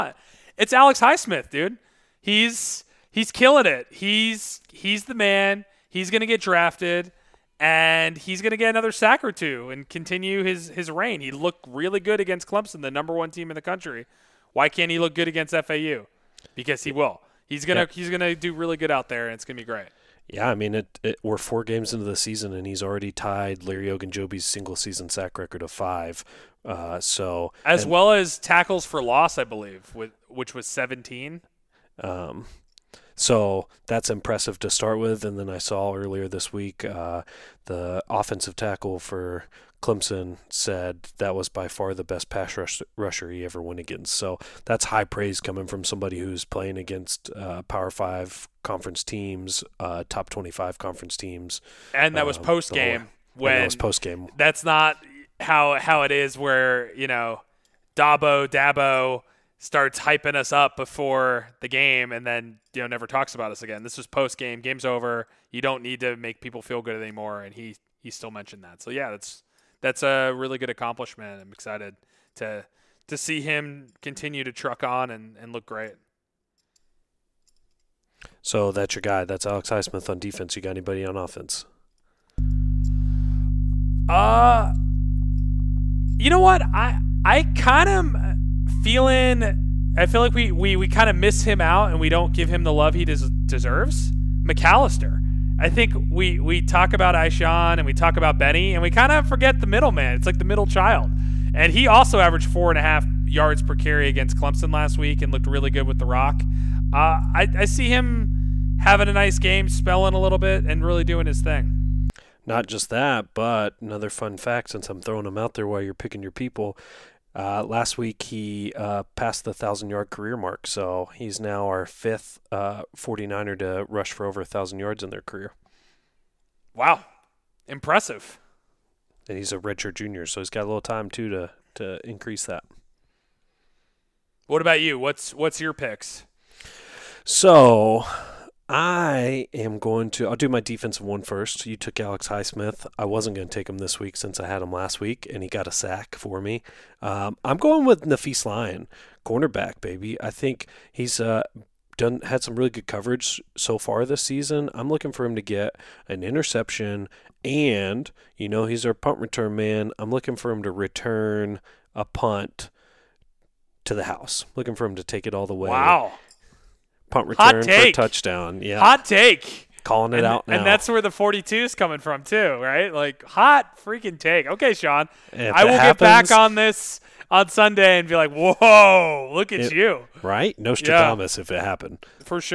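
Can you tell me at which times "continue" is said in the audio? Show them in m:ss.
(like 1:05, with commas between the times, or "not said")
0:09, 1:14.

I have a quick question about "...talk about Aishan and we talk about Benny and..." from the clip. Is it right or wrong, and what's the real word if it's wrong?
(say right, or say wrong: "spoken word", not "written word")
right.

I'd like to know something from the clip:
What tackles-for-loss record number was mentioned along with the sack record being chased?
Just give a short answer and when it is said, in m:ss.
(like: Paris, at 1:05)
17, at 0:30.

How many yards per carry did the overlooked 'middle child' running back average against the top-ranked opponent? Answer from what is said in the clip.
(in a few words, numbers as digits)
4.5.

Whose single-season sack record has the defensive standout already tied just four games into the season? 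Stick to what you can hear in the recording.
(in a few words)
Larry Ogunjobi.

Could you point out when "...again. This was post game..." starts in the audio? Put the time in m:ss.
1:03.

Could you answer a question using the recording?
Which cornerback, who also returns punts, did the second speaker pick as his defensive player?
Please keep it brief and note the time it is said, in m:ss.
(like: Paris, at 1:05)
Nafees Lyon, at 2:28.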